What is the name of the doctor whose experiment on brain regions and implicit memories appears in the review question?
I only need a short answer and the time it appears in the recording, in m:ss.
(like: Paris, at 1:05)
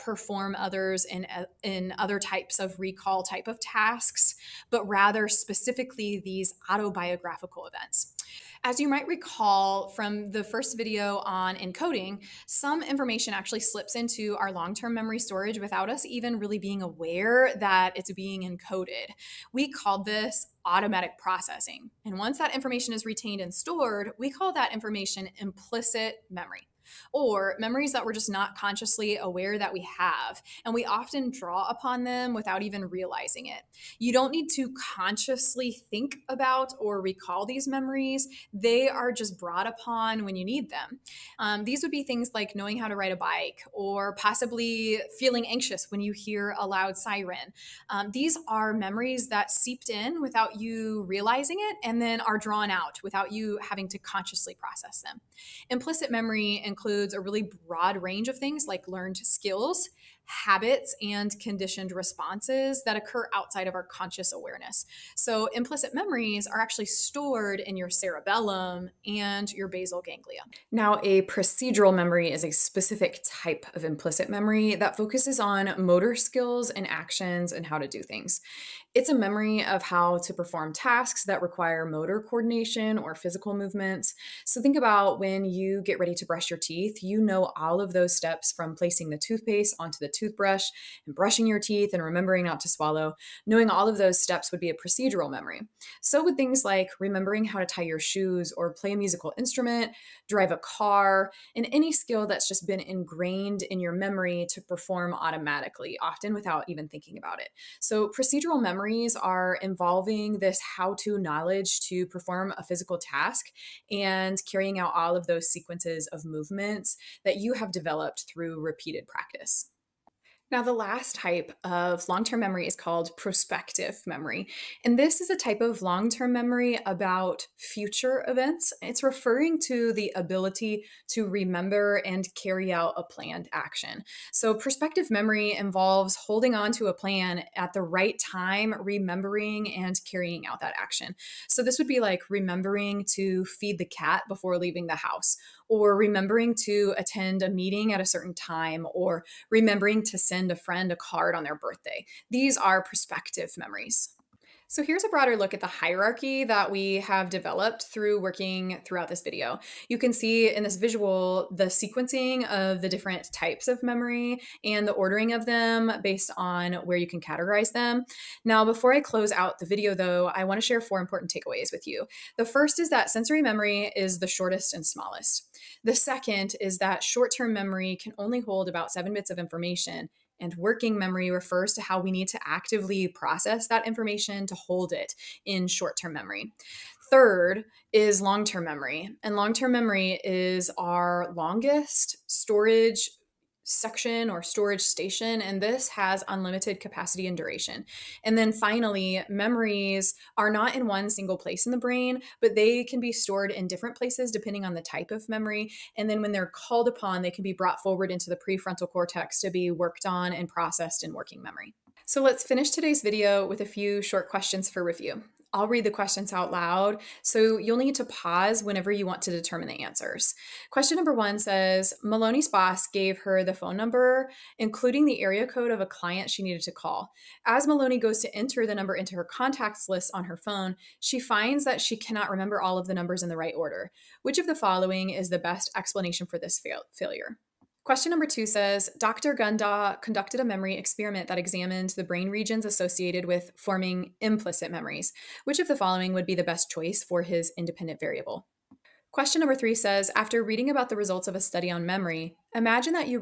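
Dr. Gunda, at 3:58.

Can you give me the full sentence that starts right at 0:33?
You don't need to consciously think about or recall these memories, they are just brought upon when you need them.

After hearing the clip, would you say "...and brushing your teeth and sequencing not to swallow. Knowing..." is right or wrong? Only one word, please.
wrong.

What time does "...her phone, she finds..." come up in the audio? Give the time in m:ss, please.
3:50.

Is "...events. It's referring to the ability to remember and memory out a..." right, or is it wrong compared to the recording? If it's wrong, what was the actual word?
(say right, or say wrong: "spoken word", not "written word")
wrong: "carry", not "memory".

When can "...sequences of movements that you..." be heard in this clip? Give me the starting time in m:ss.
1:55.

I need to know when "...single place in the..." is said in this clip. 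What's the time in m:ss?
3:21.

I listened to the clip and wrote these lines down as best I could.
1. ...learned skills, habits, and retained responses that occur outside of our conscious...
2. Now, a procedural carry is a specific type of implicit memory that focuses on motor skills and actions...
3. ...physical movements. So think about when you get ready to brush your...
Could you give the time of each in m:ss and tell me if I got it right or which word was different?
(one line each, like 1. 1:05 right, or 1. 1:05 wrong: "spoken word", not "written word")
1. 0:58 wrong: "conditioned", not "retained"
2. 1:10 wrong: "memory", not "carry"
3. 1:23 right.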